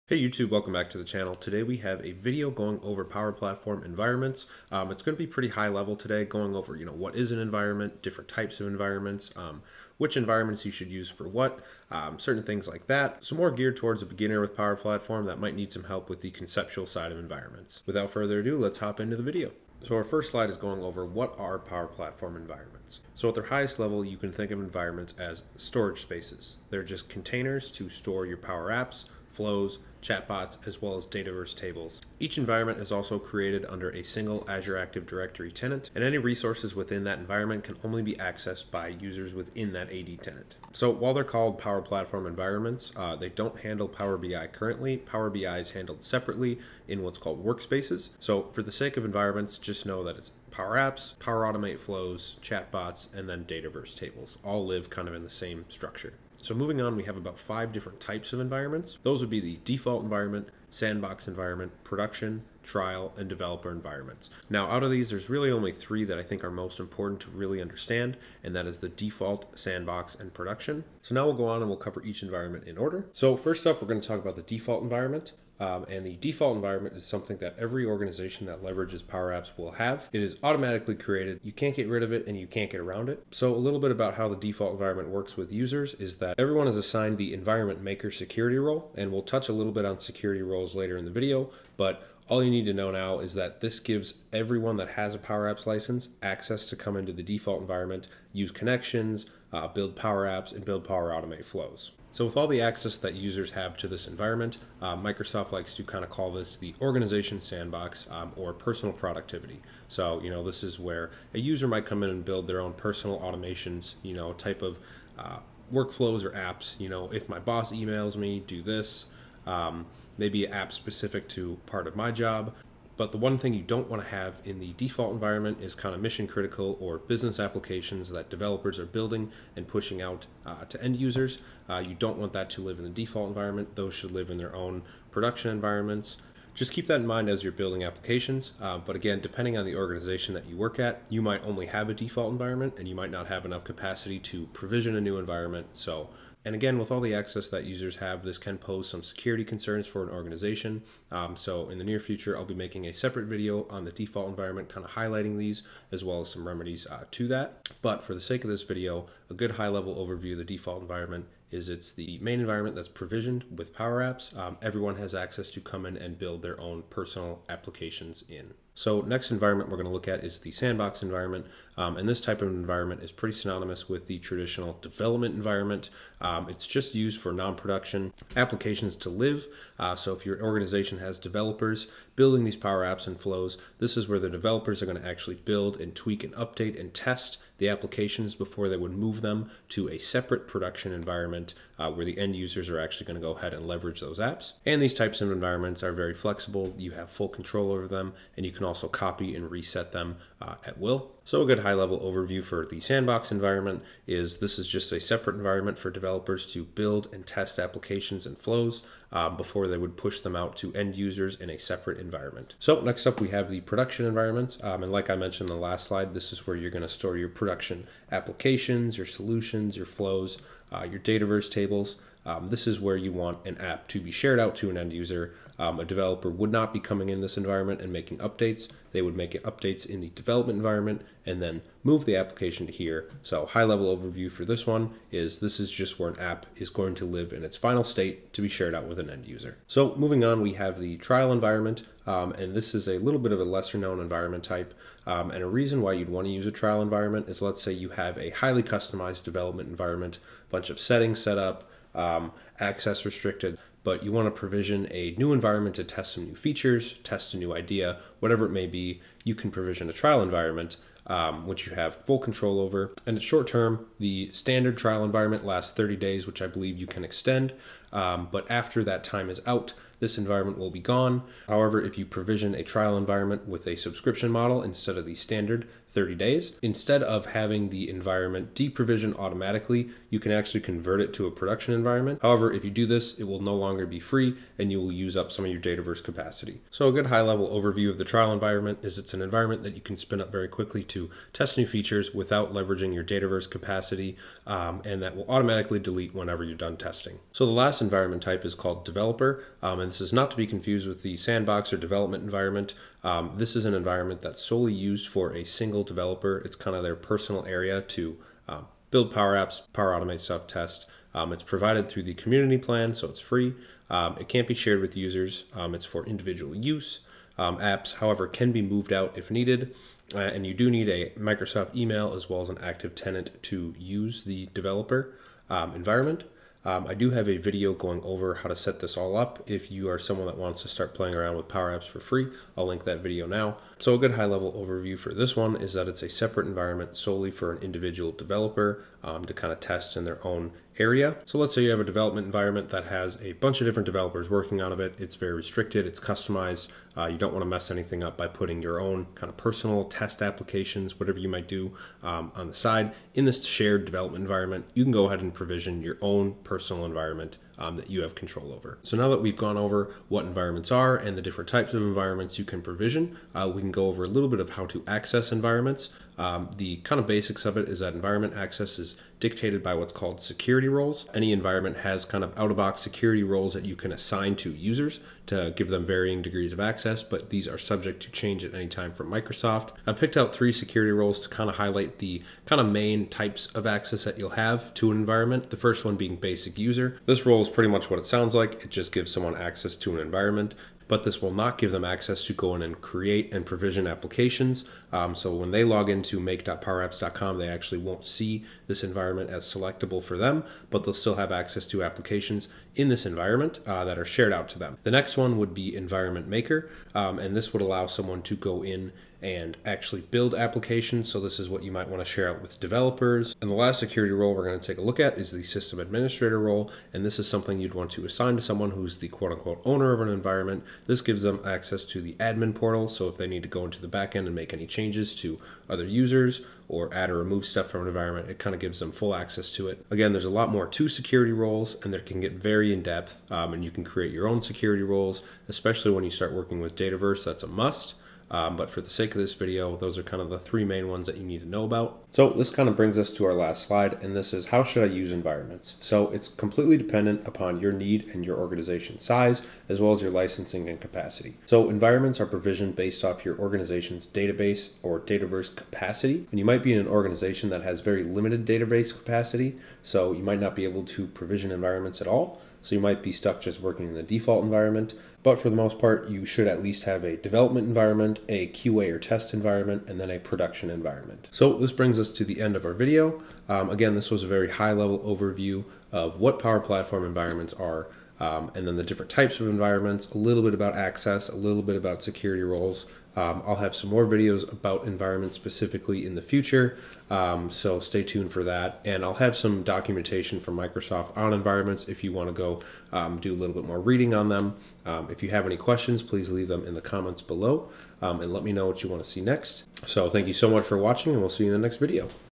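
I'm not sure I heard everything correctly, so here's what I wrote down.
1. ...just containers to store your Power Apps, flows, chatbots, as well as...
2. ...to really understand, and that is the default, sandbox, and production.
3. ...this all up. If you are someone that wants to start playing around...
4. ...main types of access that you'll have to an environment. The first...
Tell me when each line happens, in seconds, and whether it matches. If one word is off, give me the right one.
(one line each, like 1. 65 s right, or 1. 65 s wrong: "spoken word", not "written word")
1. 26 s right
2. 67 s right
3. 328 s right
4. 382 s right.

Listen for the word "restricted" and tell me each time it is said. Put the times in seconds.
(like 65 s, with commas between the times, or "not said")
253 s, 345 s.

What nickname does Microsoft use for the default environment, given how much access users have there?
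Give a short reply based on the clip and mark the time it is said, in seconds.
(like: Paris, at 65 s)
organization sandbox, at 106 s.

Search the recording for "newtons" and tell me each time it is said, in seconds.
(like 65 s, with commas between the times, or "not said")
not said.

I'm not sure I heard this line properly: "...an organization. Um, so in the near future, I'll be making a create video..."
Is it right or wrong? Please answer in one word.
wrong.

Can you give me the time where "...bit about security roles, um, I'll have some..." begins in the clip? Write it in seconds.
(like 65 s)
481 s.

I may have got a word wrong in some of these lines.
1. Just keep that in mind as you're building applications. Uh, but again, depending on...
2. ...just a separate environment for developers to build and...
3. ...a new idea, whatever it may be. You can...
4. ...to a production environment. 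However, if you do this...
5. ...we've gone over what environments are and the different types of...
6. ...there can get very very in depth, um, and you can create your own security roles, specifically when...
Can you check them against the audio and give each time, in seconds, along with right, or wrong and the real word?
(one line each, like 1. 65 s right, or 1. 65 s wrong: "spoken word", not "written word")
1. 136 s right
2. 204 s right
3. 257 s right
4. 281 s right
5. 359 s right
6. 431 s wrong: "especially", not "specifically".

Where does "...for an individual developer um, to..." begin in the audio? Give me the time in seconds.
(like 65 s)
337 s.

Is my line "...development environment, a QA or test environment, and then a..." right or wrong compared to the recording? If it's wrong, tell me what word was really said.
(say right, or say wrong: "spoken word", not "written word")
right.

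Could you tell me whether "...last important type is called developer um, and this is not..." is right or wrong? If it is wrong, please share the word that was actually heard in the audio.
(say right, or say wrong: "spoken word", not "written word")
wrong: "environment", not "important".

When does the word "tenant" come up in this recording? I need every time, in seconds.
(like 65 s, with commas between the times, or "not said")
35 s, 40 s, 322 s.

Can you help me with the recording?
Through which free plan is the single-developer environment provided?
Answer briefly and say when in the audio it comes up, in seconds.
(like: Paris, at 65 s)
community plan, at 312 s.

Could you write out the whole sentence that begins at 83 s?
So a little bit about how the default environment works with users is that everyone is assigned the environment maker security role.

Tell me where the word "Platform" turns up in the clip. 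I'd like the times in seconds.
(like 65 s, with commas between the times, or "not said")
3 s, 14 s, 21 s, 41 s, 476 s.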